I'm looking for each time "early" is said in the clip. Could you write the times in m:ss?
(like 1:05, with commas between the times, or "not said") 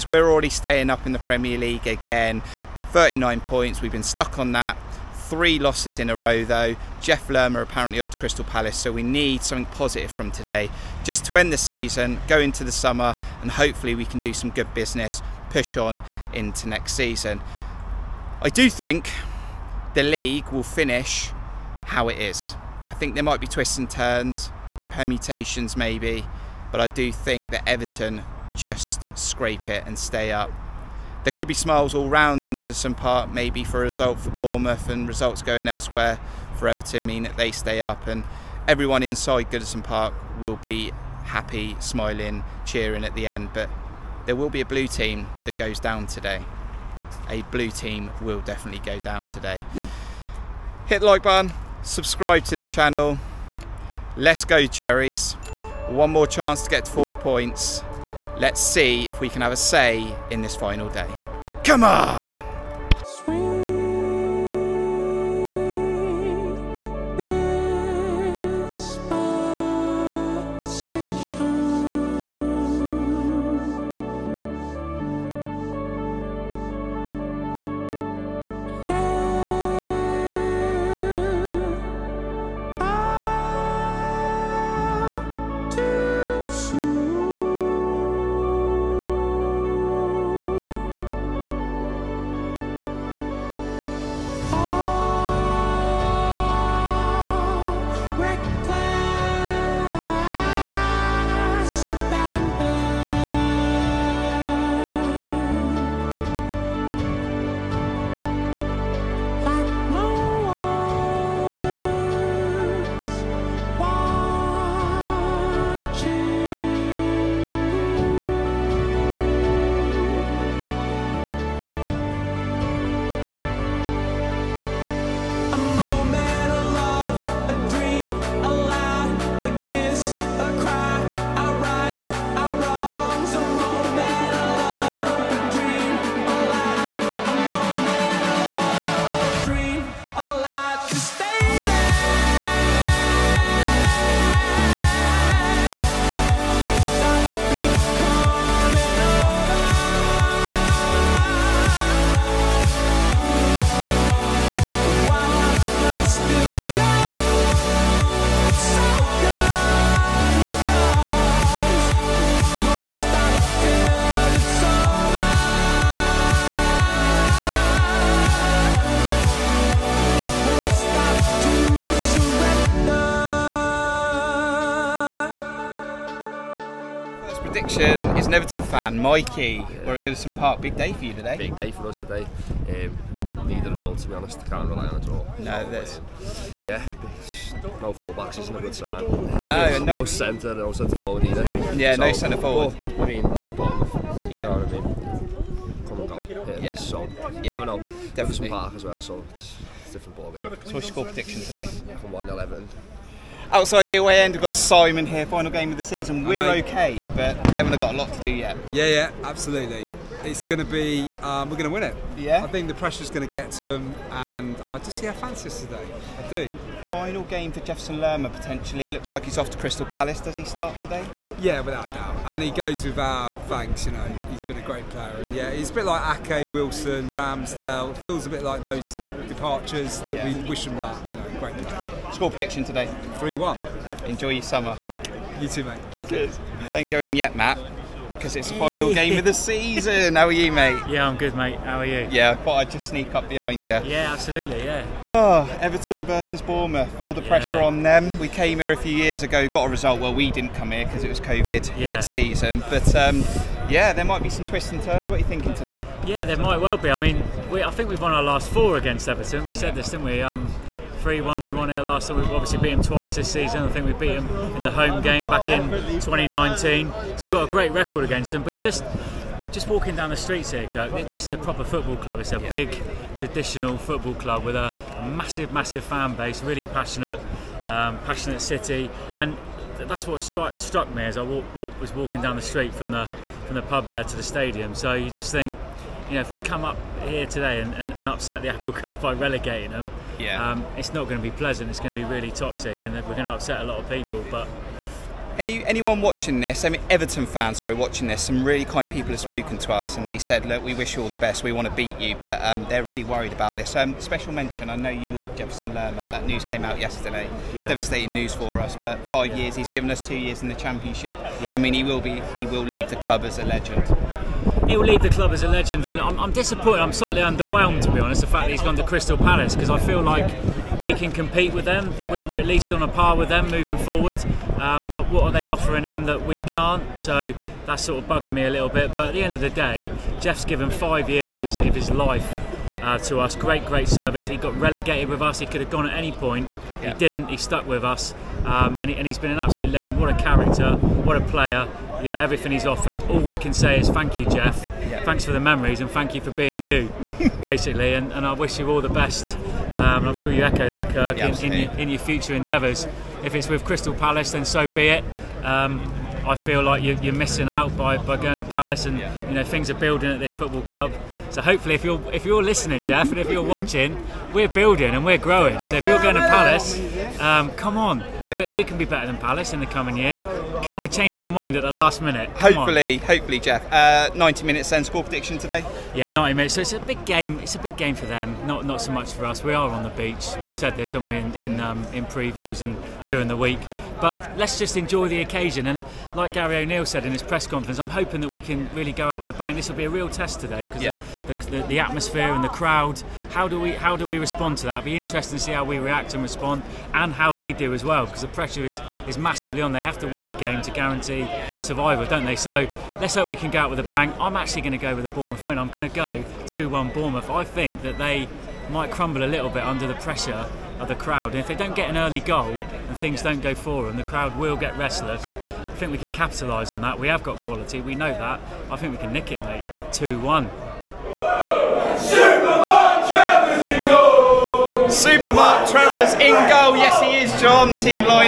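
6:51.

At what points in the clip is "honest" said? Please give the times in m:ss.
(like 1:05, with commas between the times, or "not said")
3:04, 5:17.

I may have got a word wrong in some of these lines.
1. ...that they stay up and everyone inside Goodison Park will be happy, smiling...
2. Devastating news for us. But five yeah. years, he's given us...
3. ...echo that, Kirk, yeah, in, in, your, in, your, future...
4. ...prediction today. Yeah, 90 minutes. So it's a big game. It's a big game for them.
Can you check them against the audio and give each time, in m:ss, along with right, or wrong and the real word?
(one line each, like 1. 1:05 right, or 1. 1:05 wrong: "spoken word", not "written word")
1. 0:37 right
2. 5:07 right
3. 5:50 right
4. 6:15 right.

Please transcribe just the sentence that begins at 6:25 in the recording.
And like Gary O'Neill said in his press conference, I'm hoping that we can really go out with a bang.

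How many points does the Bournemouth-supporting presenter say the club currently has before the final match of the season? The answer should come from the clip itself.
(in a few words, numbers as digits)
39.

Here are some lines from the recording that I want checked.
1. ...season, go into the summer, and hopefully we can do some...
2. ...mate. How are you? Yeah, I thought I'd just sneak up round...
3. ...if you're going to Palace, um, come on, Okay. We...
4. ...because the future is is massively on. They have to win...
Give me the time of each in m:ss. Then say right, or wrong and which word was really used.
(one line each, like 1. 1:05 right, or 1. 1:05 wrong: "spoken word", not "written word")
1. 0:11 right
2. 4:01 wrong: "behind", not "round"
3. 6:05 right
4. 6:38 wrong: "pressure", not "future".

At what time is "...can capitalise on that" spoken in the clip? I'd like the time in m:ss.
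6:55.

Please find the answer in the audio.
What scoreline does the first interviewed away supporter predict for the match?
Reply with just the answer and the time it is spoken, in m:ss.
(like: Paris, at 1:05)
3-1, at 3:53.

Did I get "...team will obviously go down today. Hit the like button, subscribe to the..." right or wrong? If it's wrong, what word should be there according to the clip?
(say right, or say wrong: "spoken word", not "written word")
wrong: "definitely", not "obviously".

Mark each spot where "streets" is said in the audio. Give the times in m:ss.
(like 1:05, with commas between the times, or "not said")
4:30, 4:42.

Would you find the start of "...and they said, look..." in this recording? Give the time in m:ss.
4:59.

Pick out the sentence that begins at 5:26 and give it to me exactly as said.
So that's sort of bugging me a little bit.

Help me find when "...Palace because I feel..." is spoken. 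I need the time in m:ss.
5:19.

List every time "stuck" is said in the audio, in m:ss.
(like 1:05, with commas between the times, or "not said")
0:04, 5:37.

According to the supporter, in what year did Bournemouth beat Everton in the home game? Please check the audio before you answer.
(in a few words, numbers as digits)
2019.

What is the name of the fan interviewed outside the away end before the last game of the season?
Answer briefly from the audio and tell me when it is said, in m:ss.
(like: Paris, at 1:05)
Simon, at 3:24.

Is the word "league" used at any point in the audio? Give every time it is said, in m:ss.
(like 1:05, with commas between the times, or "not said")
0:01, 0:20.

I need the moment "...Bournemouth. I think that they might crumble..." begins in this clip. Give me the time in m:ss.
6:46.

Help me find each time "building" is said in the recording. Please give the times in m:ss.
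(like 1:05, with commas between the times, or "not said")
5:59, 6:04.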